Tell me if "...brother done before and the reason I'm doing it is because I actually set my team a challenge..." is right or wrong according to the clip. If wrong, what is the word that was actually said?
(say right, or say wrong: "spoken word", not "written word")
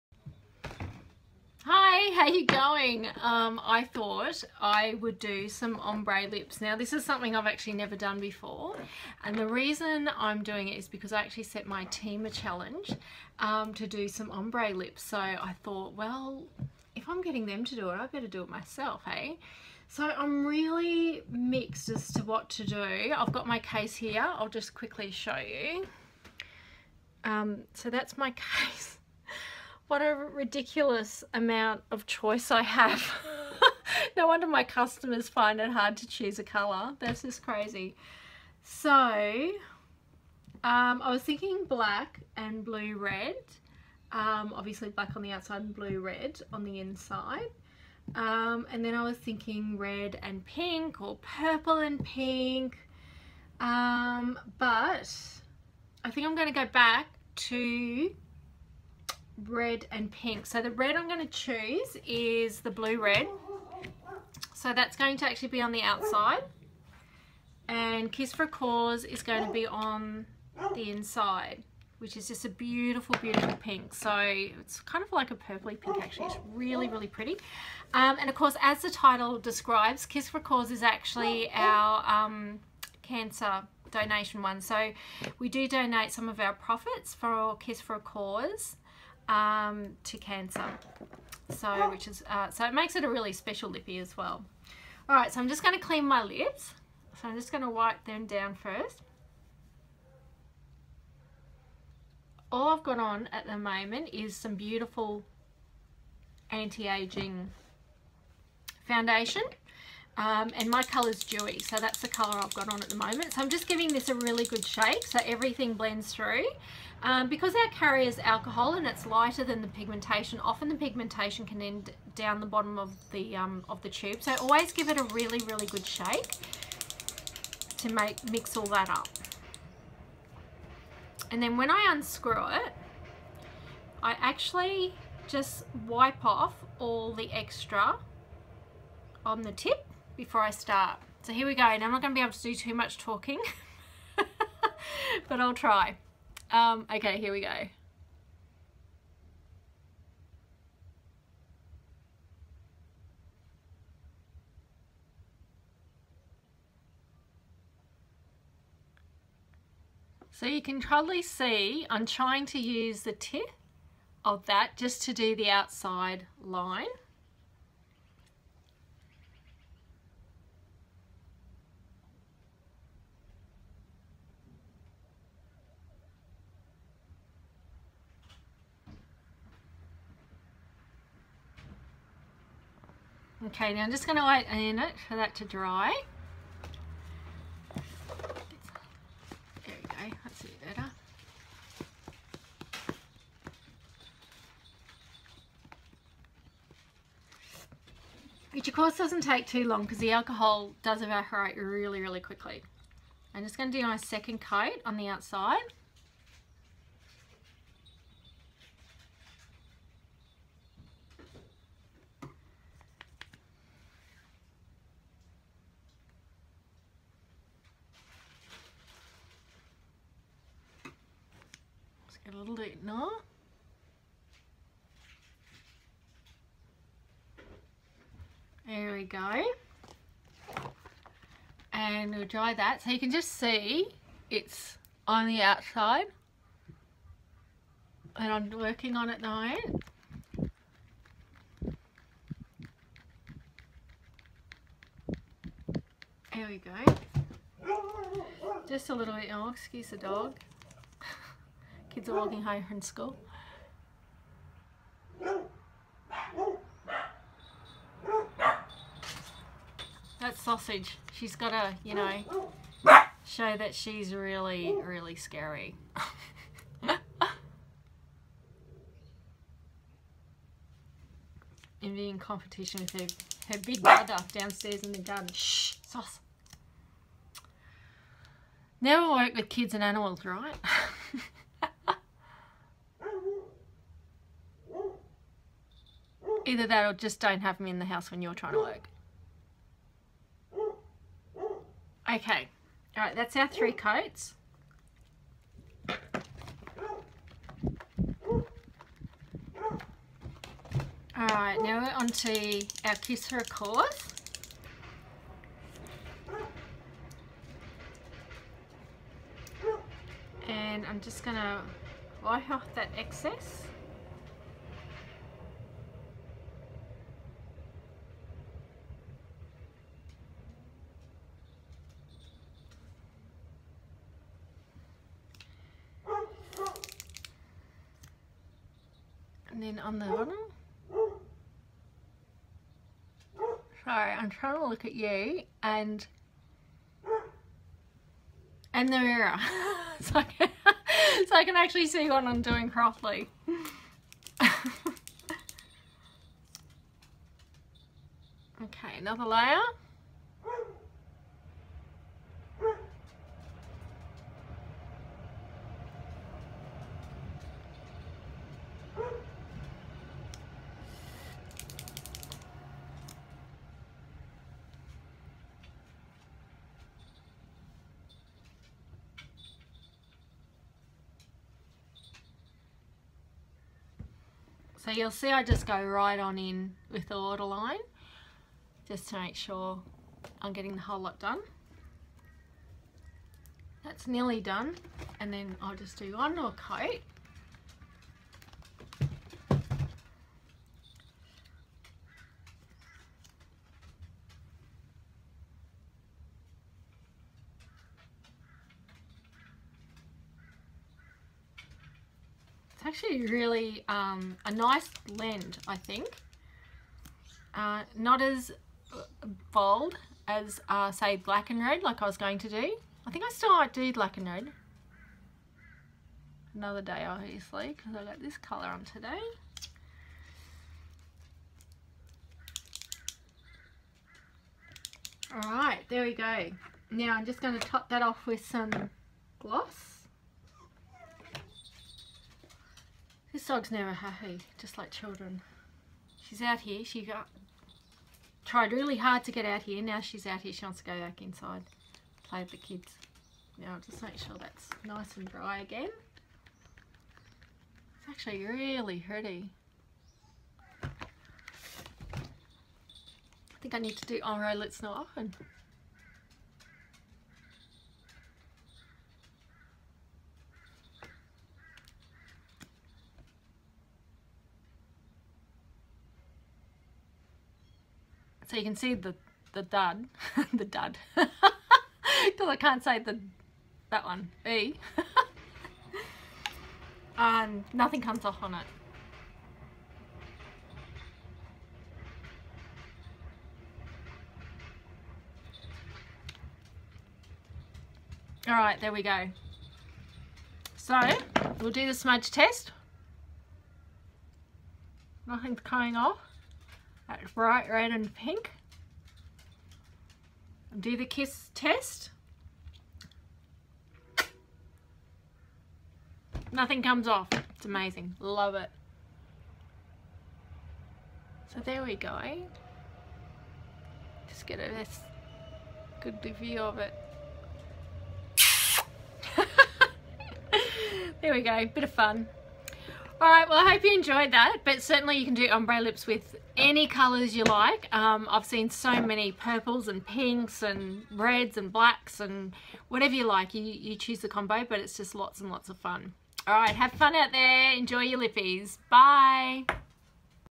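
wrong: "never", not "brother".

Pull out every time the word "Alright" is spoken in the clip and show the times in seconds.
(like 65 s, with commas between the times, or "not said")
425 s, 523 s, 536 s.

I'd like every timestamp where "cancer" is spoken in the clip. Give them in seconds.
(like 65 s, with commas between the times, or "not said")
83 s, 90 s.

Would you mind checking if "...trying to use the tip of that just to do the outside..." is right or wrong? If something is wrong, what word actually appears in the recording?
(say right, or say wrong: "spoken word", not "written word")
right.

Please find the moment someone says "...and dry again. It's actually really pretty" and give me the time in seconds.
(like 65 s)
445 s.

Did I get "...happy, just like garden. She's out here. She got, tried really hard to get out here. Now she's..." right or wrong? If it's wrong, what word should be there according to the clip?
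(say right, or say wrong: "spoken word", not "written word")
wrong: "children", not "garden".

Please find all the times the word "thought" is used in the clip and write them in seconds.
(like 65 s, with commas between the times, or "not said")
3 s, 15 s.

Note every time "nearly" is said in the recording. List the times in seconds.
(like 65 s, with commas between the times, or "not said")
384 s.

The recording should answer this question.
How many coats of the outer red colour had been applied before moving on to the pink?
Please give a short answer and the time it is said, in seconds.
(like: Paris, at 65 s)
3, at 293 s.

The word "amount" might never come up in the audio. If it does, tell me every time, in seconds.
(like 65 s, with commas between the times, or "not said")
31 s.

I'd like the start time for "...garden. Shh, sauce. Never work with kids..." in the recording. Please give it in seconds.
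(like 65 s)
274 s.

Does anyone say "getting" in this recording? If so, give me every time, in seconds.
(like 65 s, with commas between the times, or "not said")
17 s, 380 s.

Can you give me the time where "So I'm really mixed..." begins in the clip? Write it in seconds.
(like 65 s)
19 s.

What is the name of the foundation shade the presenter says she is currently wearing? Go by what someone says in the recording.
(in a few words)
dewy.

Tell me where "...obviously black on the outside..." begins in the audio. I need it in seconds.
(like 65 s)
44 s.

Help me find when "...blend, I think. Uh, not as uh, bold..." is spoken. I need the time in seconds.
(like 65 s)
405 s.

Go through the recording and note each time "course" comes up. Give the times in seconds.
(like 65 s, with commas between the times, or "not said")
78 s, 198 s.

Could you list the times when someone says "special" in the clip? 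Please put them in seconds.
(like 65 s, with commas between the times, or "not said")
93 s.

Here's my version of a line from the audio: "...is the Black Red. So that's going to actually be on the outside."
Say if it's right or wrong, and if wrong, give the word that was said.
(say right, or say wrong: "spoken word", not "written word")
wrong: "Blu", not "Black".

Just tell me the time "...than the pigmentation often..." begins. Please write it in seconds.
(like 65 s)
119 s.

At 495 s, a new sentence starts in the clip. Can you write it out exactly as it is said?
Nothing's coming off bright red and pink.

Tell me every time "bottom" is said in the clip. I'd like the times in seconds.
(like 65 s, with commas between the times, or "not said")
122 s, 330 s.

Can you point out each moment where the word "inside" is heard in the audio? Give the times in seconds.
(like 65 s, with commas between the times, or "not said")
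46 s, 70 s, 441 s.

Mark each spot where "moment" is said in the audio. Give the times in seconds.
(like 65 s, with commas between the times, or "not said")
103 s, 112 s.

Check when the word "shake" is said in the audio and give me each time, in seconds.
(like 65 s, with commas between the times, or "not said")
114 s, 125 s.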